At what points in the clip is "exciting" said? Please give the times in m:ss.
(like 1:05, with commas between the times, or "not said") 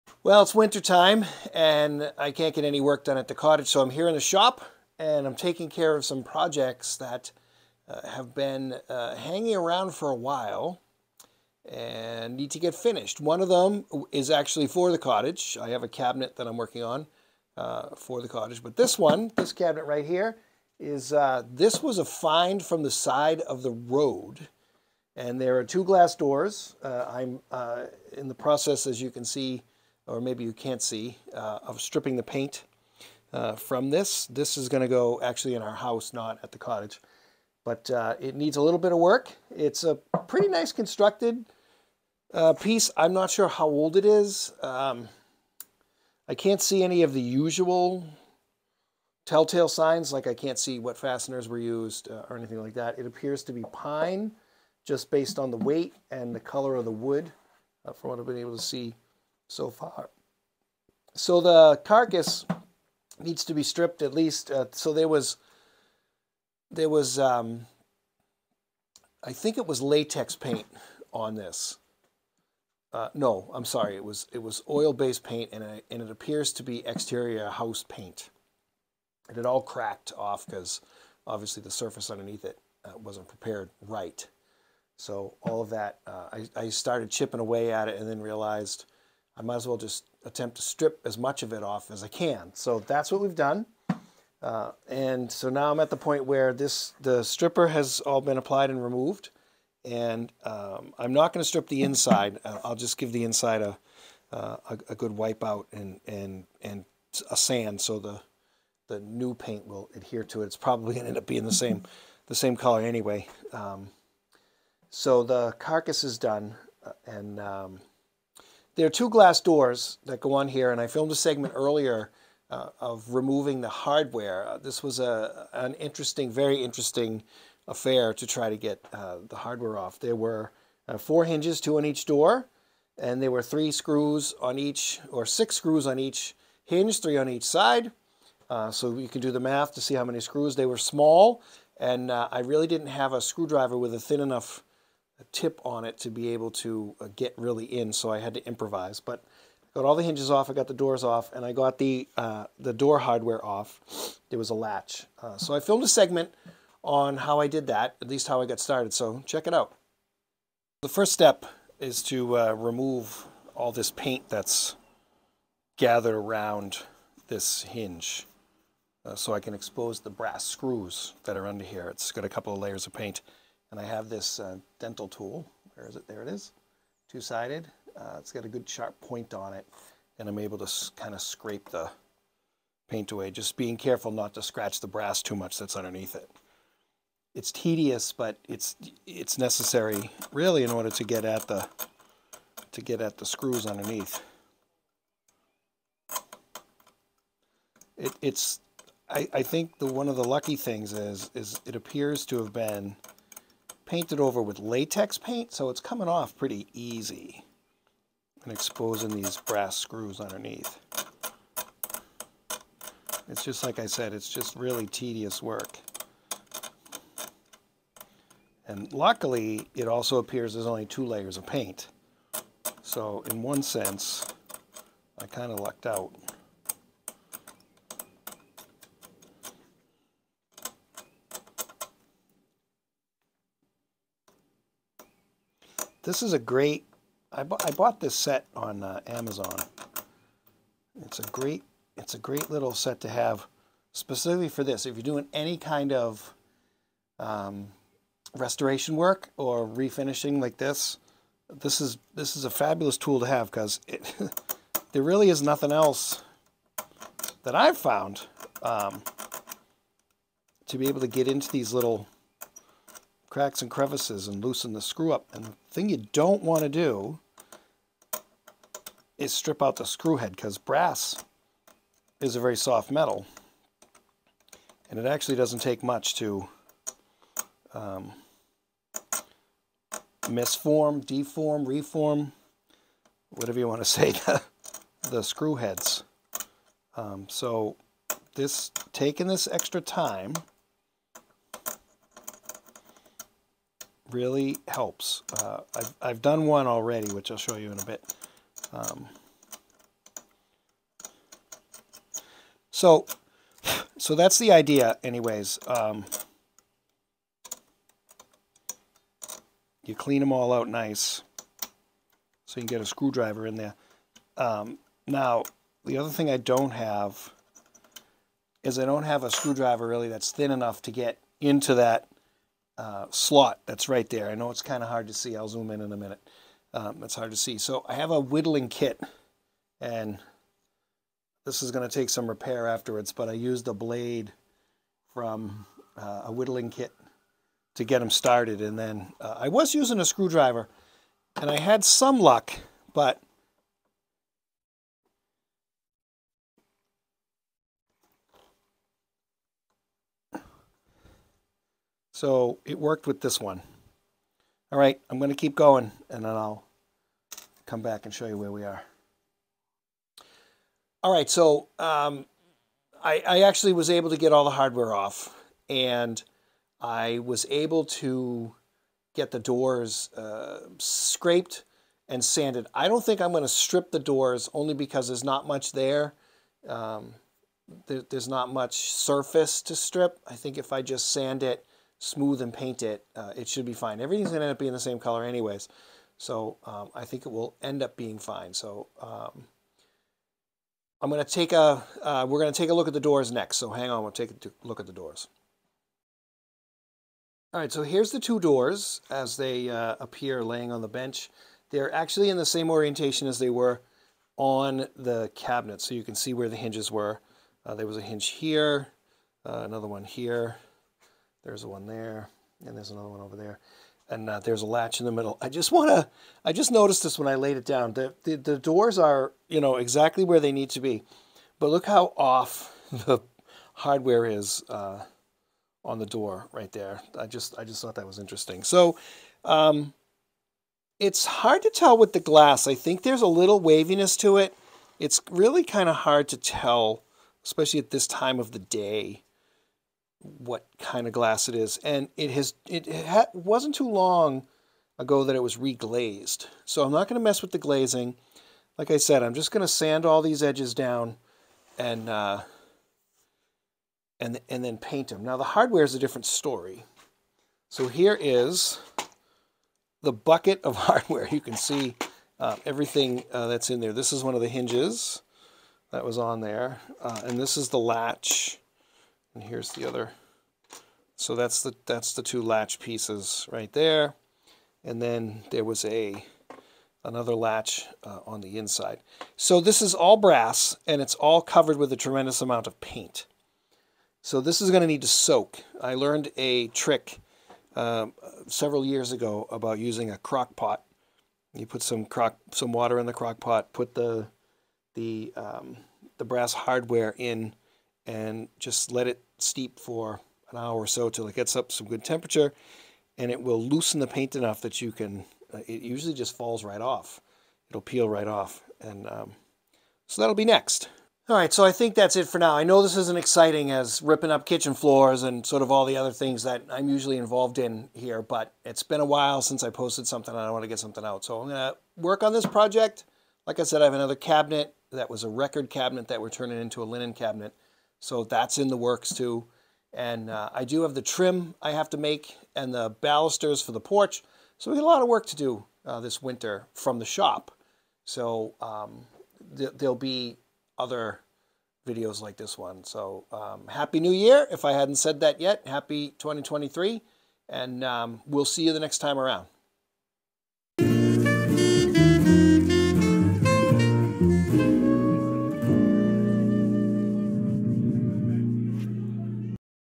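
8:33.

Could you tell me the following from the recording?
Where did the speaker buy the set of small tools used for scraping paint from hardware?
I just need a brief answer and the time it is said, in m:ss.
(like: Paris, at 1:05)
Amazon, at 3:59.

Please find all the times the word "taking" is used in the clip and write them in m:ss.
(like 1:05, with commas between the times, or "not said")
0:05, 4:48.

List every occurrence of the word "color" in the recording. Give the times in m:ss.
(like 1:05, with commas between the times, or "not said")
0:56, 1:52, 6:24.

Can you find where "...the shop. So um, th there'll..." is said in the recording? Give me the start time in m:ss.
8:56.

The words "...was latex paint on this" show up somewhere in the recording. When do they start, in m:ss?
1:09.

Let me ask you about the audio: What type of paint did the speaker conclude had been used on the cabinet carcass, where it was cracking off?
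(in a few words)
Exterior house paint.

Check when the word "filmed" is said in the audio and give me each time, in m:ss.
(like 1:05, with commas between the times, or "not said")
2:00, 2:35.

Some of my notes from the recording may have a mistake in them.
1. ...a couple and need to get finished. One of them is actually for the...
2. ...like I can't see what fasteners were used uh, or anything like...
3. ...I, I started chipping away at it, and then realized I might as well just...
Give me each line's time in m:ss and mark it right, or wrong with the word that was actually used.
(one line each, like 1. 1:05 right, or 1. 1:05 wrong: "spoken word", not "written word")
1. 0:10 wrong: "while", not "couple"
2. 0:50 right
3. 1:26 right.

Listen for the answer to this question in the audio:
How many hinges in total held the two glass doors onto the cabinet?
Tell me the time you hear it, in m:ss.
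2:10.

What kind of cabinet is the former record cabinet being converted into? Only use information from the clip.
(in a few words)
Linen cabinet.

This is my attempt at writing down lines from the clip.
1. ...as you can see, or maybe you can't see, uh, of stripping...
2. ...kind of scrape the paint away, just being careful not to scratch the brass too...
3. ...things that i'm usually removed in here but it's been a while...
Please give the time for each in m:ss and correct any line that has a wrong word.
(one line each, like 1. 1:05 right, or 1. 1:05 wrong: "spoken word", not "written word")
1. 0:28 right
2. 3:00 right
3. 8:36 wrong: "involved", not "removed".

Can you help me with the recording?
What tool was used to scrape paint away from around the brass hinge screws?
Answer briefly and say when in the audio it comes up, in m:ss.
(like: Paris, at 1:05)
Dental tool, at 2:54.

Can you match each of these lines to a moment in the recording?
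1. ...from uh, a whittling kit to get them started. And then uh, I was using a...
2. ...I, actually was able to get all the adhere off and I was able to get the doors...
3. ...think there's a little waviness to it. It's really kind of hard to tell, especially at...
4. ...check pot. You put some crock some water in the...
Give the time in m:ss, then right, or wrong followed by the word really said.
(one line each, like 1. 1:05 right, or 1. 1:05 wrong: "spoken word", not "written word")
1. 5:35 right
2. 6:03 wrong: "hardware", not "adhere"
3. 7:12 right
4. 8:10 wrong: "crock", not "check".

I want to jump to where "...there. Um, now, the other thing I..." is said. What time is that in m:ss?
5:13.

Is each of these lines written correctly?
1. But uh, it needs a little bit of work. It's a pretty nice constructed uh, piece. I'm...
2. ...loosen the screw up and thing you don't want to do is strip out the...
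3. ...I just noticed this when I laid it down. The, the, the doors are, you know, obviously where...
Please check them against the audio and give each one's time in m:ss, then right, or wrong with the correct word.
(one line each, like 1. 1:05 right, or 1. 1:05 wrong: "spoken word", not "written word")
1. 0:37 right
2. 4:24 right
3. 6:56 wrong: "exactly", not "obviously".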